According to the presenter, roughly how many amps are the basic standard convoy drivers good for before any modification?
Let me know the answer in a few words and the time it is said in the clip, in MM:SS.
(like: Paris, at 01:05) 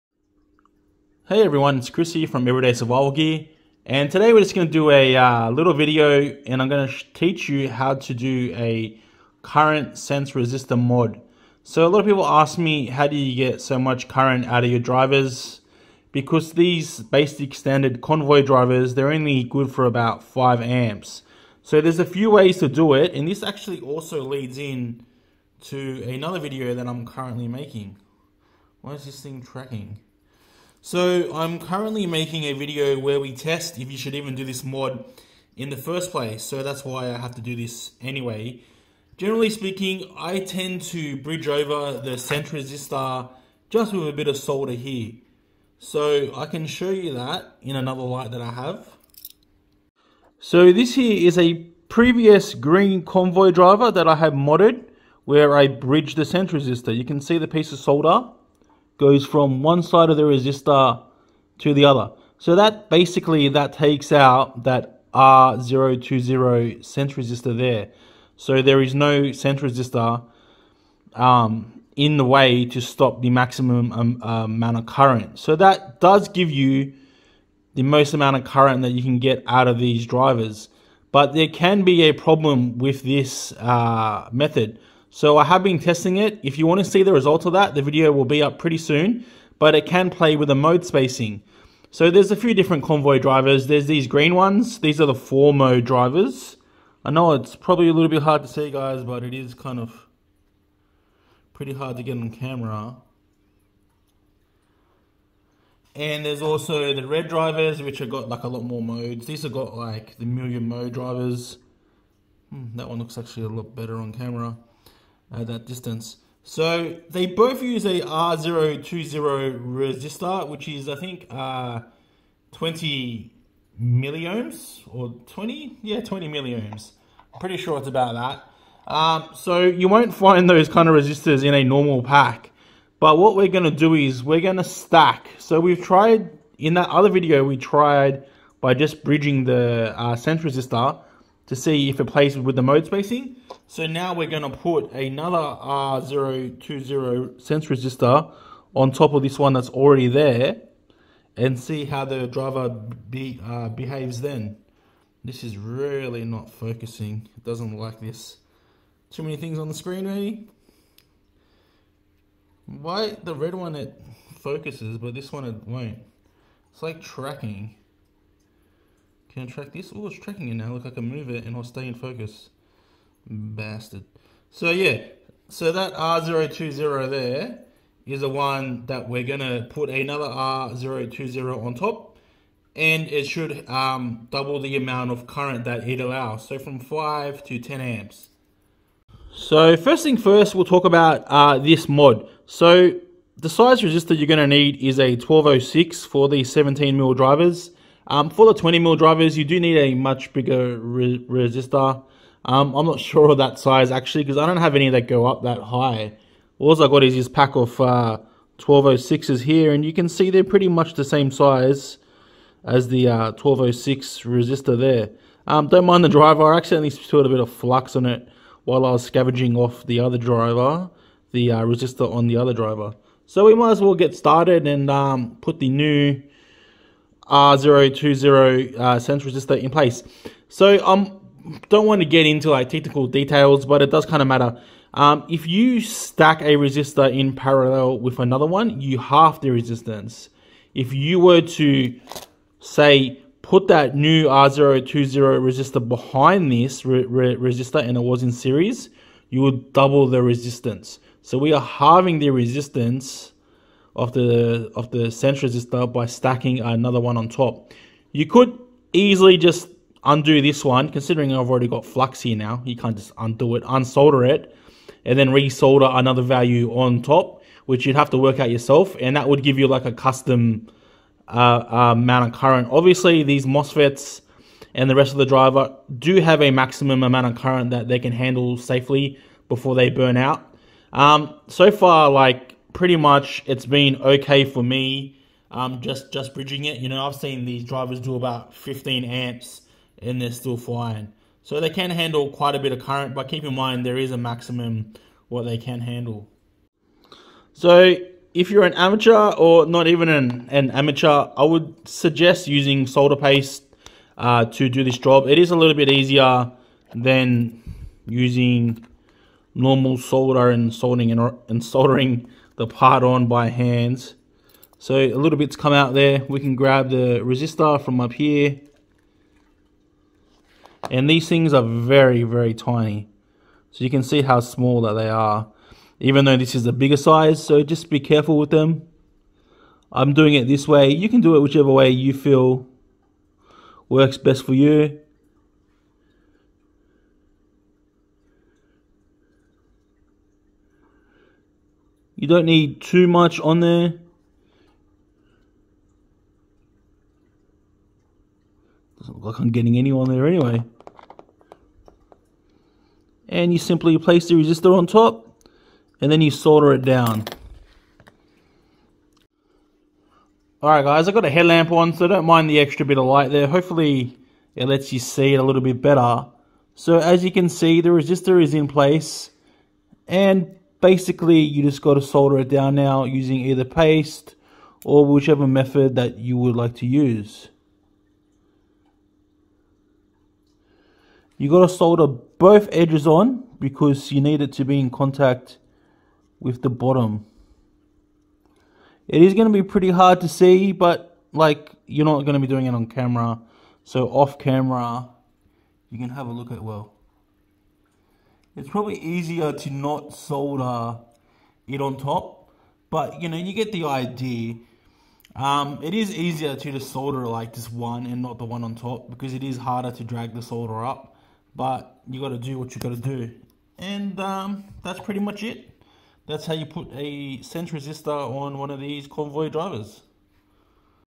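5 amps, at 00:20.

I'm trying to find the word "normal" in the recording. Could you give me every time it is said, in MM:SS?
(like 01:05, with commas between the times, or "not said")
02:11, 05:09.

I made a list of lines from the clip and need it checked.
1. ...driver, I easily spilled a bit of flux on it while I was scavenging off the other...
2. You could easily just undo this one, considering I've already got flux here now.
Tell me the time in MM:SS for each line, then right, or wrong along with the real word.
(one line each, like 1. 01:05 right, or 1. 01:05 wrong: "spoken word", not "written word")
1. 03:36 wrong: "accidentally", not "easily"
2. 04:18 right.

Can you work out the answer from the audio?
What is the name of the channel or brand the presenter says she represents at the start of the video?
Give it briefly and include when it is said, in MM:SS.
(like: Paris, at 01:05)
Everyday Survival Gear, at 00:02.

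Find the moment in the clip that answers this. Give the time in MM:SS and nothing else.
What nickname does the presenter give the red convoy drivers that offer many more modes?
01:50.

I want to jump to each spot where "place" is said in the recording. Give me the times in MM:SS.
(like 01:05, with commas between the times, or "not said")
00:36, 03:49, 05:53, 06:08.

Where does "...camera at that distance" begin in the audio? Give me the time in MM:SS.
01:54.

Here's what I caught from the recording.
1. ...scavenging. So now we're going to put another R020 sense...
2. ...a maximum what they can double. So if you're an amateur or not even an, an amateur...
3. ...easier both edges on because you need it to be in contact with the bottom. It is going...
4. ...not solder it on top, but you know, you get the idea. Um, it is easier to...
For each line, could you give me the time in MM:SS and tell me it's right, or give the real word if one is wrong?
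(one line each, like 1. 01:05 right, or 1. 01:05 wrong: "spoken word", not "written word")
1. 02:22 wrong: "spacing", not "scavenging"
2. 04:54 wrong: "handle", not "double"
3. 06:21 wrong: "solder", not "easier"
4. 06:39 right.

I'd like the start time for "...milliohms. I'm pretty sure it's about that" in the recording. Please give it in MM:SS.
02:06.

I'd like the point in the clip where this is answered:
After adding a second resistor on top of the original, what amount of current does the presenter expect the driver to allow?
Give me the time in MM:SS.
03:07.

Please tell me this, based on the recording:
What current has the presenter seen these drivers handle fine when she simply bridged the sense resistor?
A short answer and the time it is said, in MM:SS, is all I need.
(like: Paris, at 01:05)
15 amps, at 04:48.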